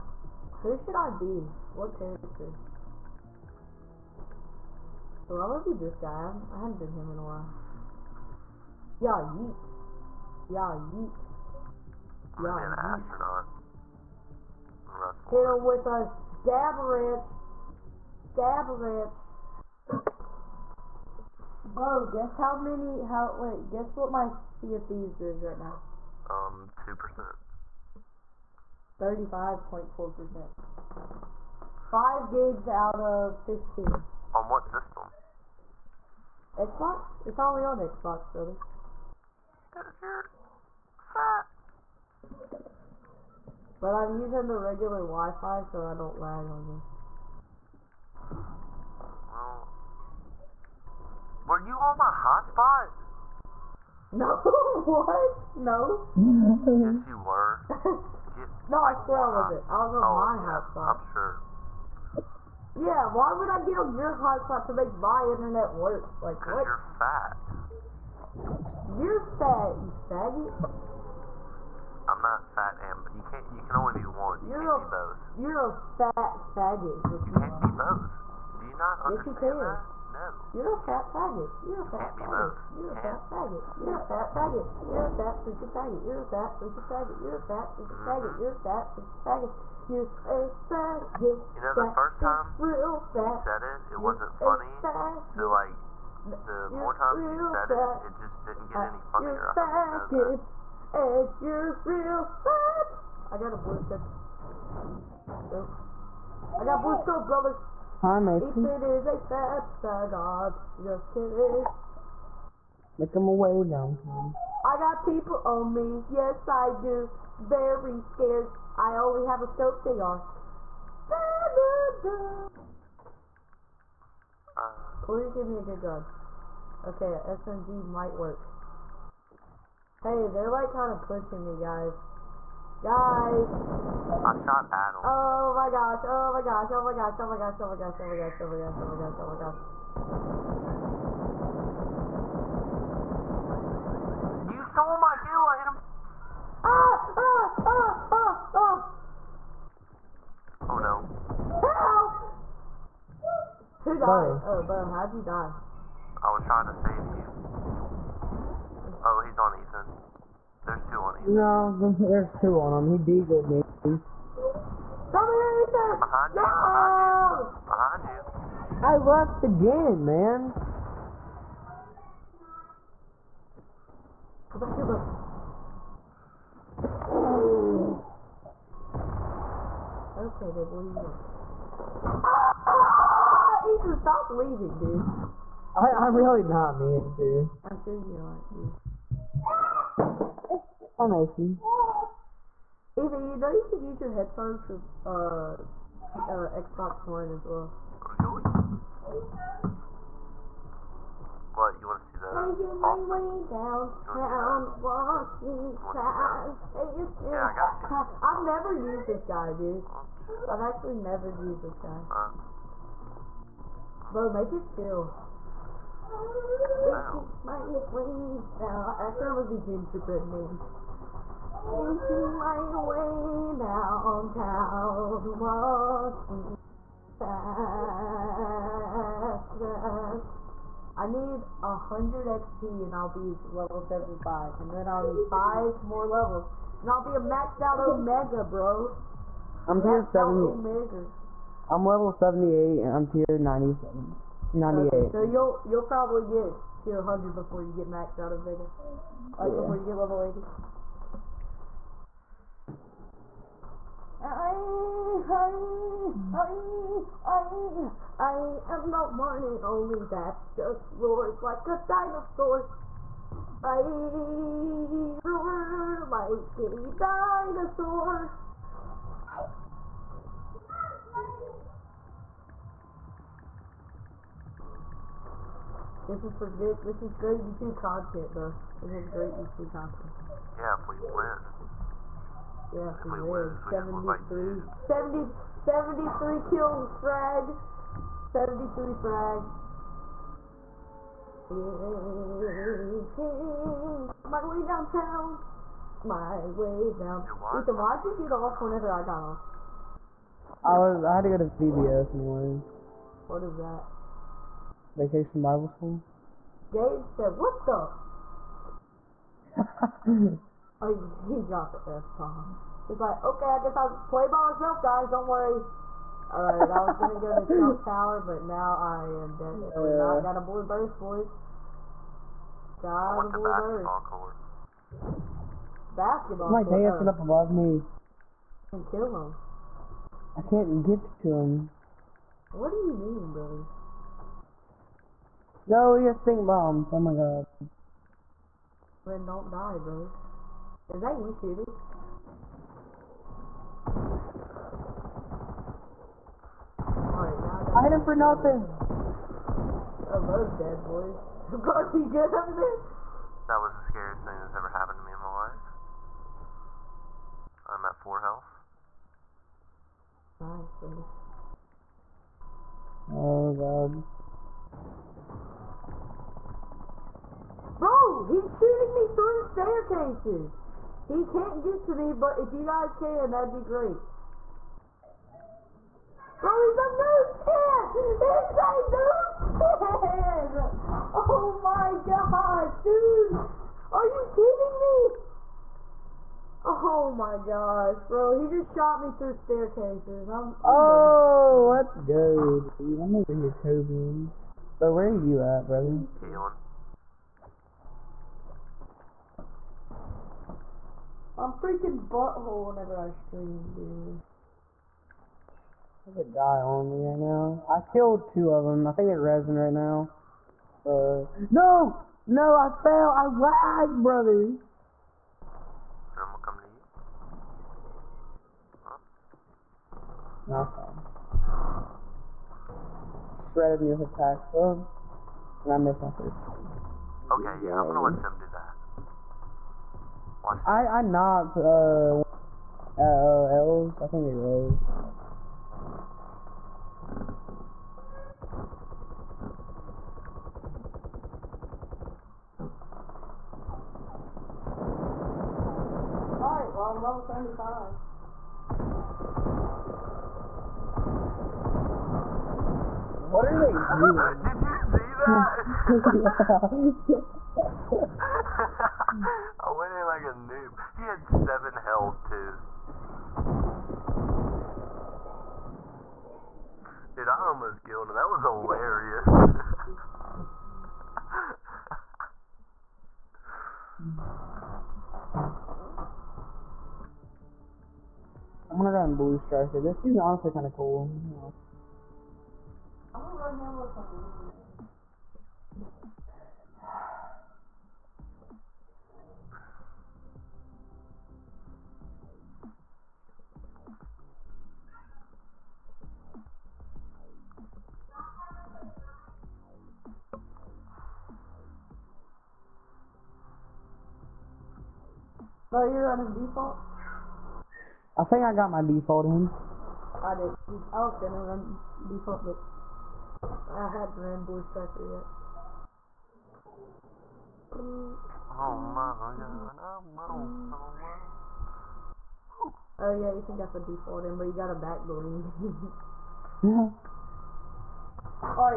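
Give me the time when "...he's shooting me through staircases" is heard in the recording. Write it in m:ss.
6:08.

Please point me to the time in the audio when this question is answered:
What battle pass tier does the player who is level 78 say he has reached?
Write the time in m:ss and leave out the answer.
4:03.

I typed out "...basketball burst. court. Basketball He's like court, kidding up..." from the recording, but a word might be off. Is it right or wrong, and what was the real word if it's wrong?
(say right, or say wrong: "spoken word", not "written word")
wrong: "dancing", not "kidding".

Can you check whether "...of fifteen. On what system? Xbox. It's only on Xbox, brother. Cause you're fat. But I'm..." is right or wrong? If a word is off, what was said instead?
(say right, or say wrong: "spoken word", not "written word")
right.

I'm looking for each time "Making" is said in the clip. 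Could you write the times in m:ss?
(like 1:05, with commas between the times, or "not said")
3:22, 3:36, 3:41.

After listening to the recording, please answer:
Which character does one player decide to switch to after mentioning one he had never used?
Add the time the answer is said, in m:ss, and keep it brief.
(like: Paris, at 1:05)
Gingerbread man, at 3:39.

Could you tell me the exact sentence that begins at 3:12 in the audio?
Ethan, you know you can use your headphones for uh, uh, Xbox One as well.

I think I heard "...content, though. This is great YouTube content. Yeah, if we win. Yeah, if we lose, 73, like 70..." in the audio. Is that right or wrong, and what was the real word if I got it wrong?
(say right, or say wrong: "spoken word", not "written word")
right.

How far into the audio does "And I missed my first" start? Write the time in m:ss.
7:05.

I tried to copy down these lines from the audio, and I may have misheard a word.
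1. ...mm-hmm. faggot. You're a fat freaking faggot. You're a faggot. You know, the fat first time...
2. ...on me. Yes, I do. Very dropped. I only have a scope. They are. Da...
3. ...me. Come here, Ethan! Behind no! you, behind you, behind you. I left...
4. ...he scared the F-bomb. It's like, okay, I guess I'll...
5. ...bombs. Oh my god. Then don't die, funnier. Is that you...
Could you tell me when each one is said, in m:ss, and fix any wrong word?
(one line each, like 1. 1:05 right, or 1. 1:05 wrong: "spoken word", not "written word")
1. 1:27 right
2. 1:55 wrong: "scared", not "dropped"
3. 2:43 right
4. 5:11 wrong: "dropped", not "scared"
5. 5:36 wrong: "brother", not "funnier".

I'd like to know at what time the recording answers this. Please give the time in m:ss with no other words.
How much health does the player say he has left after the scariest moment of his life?
5:57.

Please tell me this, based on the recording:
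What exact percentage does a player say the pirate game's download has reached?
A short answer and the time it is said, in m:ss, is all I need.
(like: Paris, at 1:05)
35.4%, at 0:28.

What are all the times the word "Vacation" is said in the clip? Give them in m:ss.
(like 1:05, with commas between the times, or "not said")
5:04.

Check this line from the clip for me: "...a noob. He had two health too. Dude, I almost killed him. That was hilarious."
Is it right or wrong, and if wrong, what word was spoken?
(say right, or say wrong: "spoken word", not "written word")
wrong: "seven", not "two".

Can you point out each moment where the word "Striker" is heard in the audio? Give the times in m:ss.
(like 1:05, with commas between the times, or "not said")
7:59, 8:34.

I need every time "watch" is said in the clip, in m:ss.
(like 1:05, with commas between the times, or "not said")
4:57, 7:10.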